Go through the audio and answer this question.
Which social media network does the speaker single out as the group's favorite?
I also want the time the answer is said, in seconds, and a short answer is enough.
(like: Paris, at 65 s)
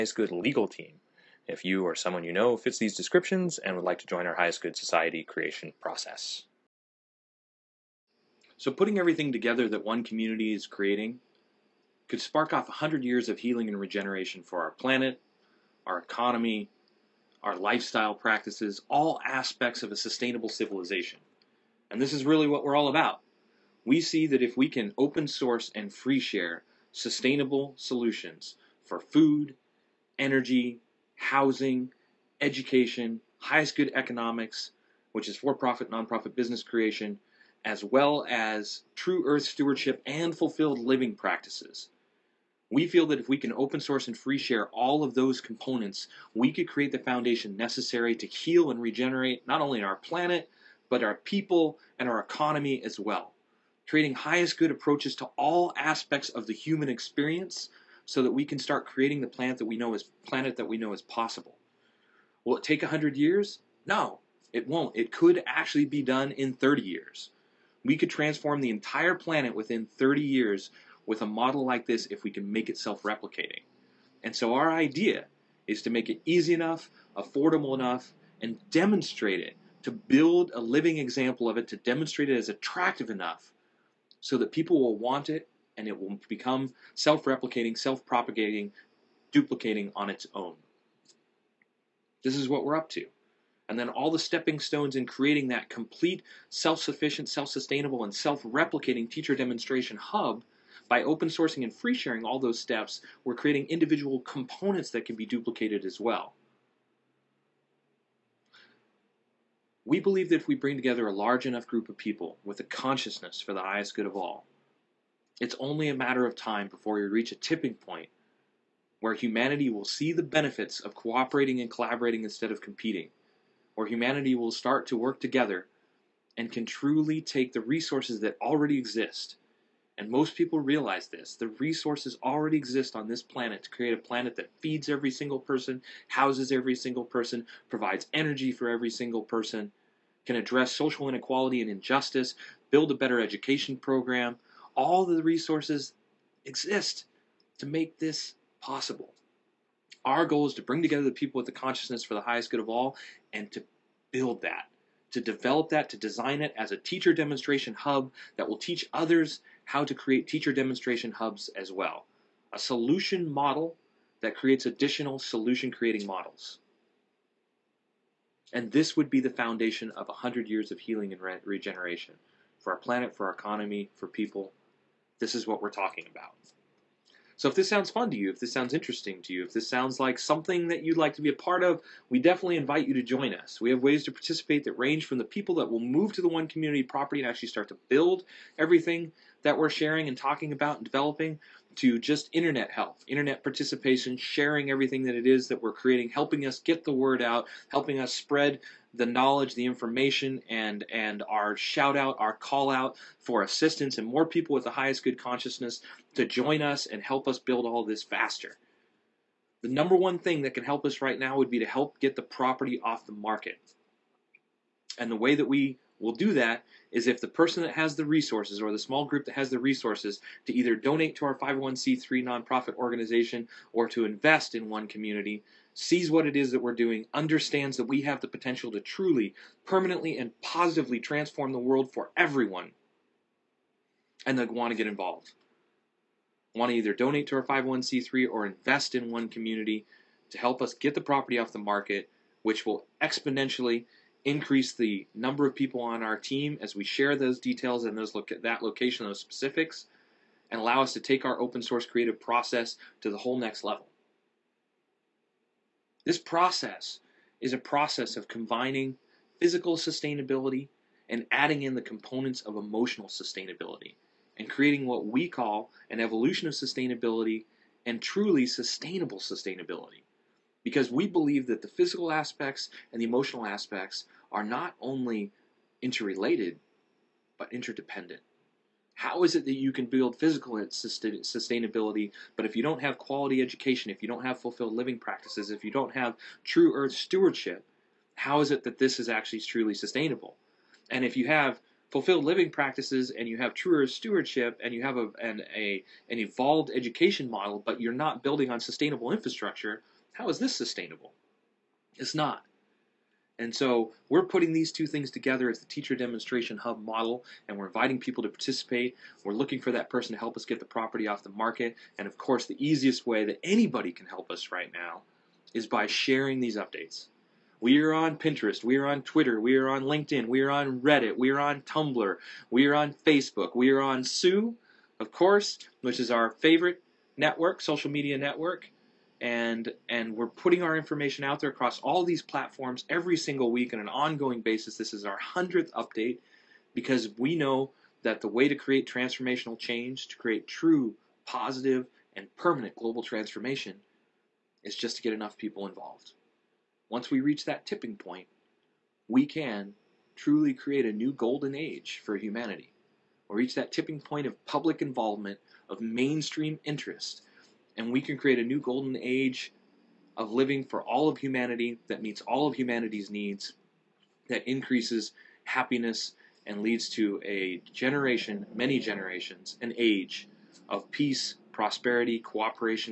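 Tsu, at 324 s.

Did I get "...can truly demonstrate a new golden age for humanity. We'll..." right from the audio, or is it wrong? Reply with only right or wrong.
wrong.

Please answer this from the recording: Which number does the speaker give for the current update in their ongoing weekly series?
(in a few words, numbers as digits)
100th.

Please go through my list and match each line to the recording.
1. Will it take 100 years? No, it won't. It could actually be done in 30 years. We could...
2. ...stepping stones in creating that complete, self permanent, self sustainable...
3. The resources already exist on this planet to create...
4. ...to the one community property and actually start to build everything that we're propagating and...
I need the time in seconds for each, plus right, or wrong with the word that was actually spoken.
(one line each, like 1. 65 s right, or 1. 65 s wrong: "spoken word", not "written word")
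1. 62 s right
2. 94 s wrong: "sufficient", not "permanent"
3. 131 s right
4. 186 s wrong: "sharing", not "propagating".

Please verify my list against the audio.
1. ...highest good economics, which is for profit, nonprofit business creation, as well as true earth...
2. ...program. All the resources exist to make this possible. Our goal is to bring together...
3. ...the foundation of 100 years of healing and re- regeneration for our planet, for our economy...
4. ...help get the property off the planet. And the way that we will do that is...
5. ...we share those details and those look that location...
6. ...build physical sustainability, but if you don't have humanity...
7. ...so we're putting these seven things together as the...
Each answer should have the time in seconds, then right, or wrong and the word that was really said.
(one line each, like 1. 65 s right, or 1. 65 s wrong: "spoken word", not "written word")
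1. 33 s right
2. 143 s right
3. 169 s right
4. 211 s wrong: "market", not "planet"
5. 246 s right
6. 279 s wrong: "quality", not "humanity"
7. 303 s wrong: "two", not "seven".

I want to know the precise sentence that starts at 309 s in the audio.
We're looking for that person to help us get the property off the market.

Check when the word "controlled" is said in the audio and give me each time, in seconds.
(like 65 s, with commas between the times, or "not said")
not said.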